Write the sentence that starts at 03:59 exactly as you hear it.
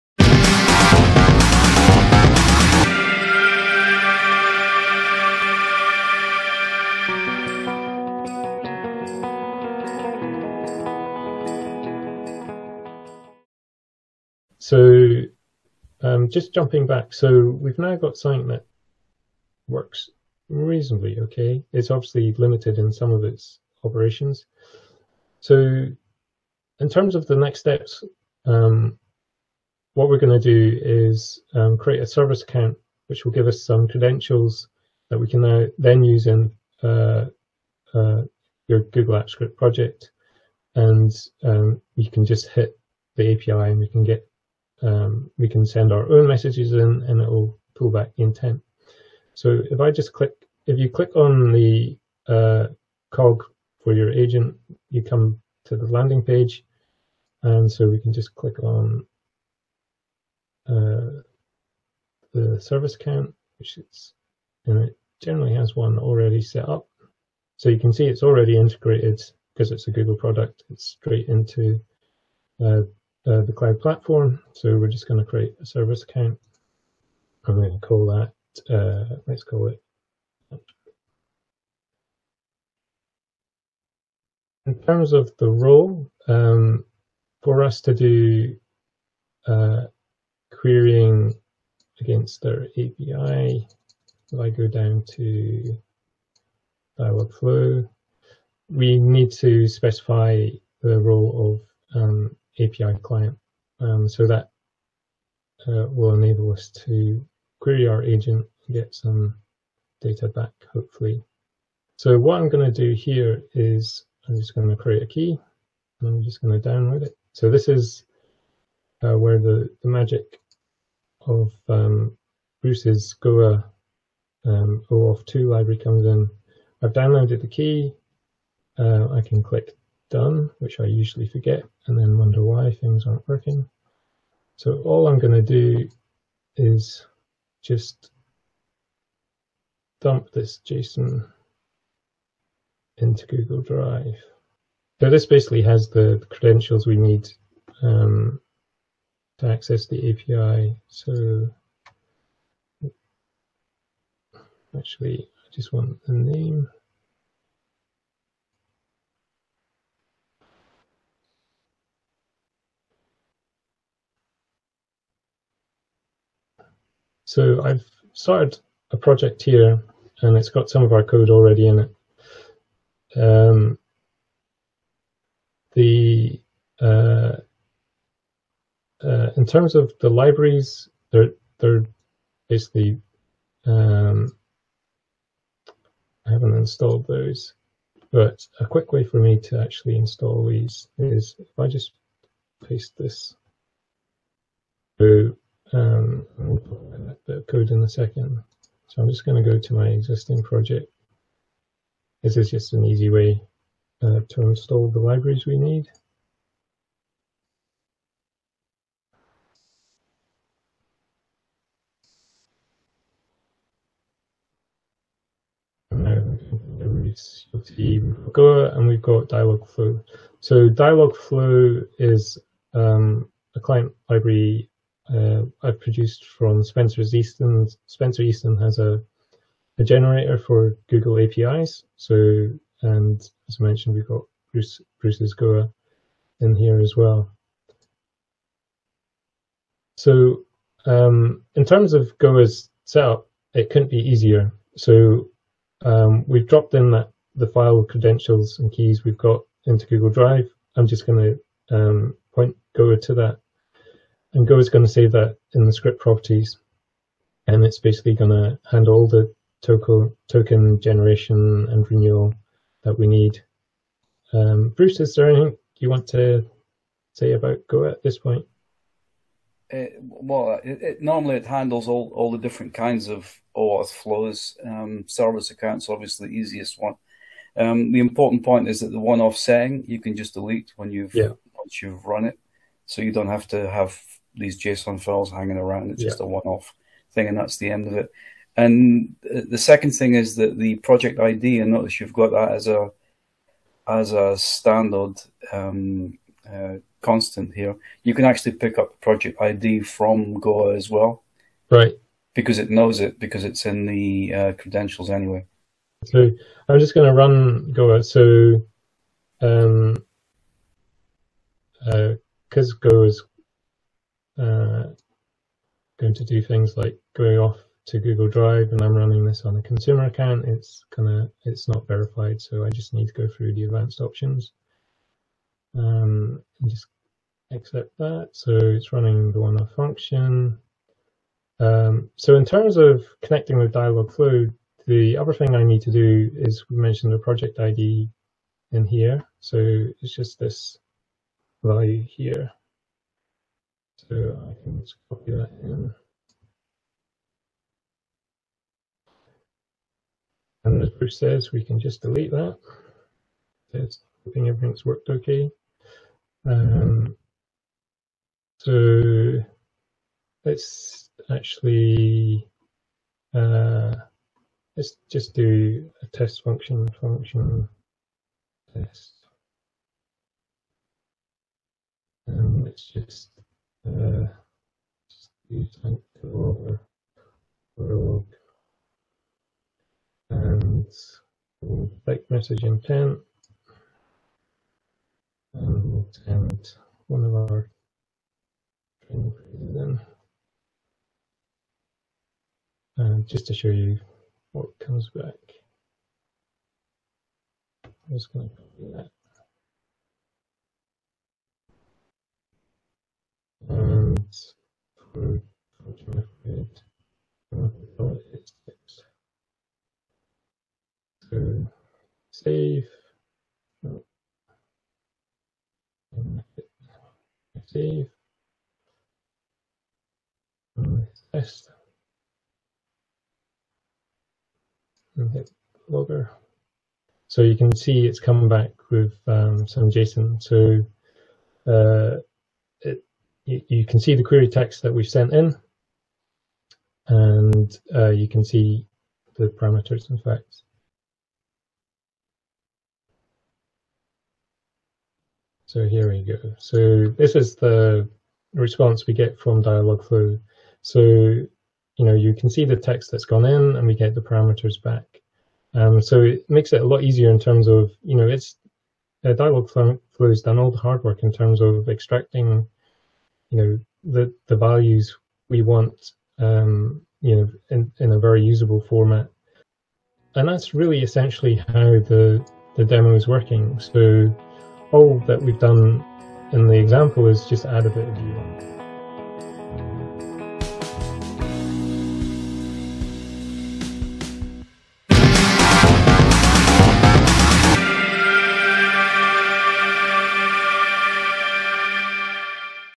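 So um, in terms of Goa's setup, it couldn't be easier.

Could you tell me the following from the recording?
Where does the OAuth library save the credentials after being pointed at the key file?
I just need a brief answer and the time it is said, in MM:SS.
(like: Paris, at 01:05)
script properties, at 04:15.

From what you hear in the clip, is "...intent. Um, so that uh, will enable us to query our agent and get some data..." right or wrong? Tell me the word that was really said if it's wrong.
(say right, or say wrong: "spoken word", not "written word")
wrong: "client", not "intent".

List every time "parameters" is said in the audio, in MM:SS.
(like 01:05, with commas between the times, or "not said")
07:19, 07:34.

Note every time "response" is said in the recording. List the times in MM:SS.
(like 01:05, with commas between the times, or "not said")
07:28.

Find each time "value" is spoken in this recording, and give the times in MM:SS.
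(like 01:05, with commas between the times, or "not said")
05:41, 07:44.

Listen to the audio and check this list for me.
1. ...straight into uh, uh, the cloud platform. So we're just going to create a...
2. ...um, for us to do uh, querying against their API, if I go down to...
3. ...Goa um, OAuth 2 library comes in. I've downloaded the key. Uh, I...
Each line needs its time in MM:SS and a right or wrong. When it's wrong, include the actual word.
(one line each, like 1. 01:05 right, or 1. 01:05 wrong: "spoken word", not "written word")
1. 01:10 right
2. 01:26 right
3. 02:03 right.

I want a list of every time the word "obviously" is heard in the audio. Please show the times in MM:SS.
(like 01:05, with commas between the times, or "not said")
00:21, 04:35.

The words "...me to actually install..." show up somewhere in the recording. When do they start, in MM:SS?
03:09.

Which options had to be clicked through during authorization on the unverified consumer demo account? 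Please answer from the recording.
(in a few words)
advanced options.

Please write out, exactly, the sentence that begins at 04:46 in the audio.
just a one-off thing, and that's the end of it.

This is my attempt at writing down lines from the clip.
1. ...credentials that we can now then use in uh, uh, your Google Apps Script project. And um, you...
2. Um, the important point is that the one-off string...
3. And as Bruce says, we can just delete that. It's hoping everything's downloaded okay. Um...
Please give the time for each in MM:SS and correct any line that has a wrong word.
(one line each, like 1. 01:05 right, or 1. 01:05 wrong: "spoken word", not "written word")
1. 00:33 right
2. 04:37 wrong: "setting", not "string"
3. 05:50 wrong: "worked", not "downloaded".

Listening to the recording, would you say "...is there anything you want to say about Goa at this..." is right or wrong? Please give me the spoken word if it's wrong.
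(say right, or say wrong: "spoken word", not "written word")
right.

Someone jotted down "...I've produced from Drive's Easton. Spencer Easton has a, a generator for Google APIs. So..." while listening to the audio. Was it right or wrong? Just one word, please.
wrong.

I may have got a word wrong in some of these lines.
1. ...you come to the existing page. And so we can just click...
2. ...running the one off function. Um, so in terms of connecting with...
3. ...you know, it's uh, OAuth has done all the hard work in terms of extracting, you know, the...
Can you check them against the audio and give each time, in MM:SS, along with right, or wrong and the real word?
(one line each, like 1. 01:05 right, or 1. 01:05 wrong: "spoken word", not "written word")
1. 00:54 wrong: "landing", not "existing"
2. 05:28 right
3. 07:38 wrong: "Dialogflow", not "OAuth".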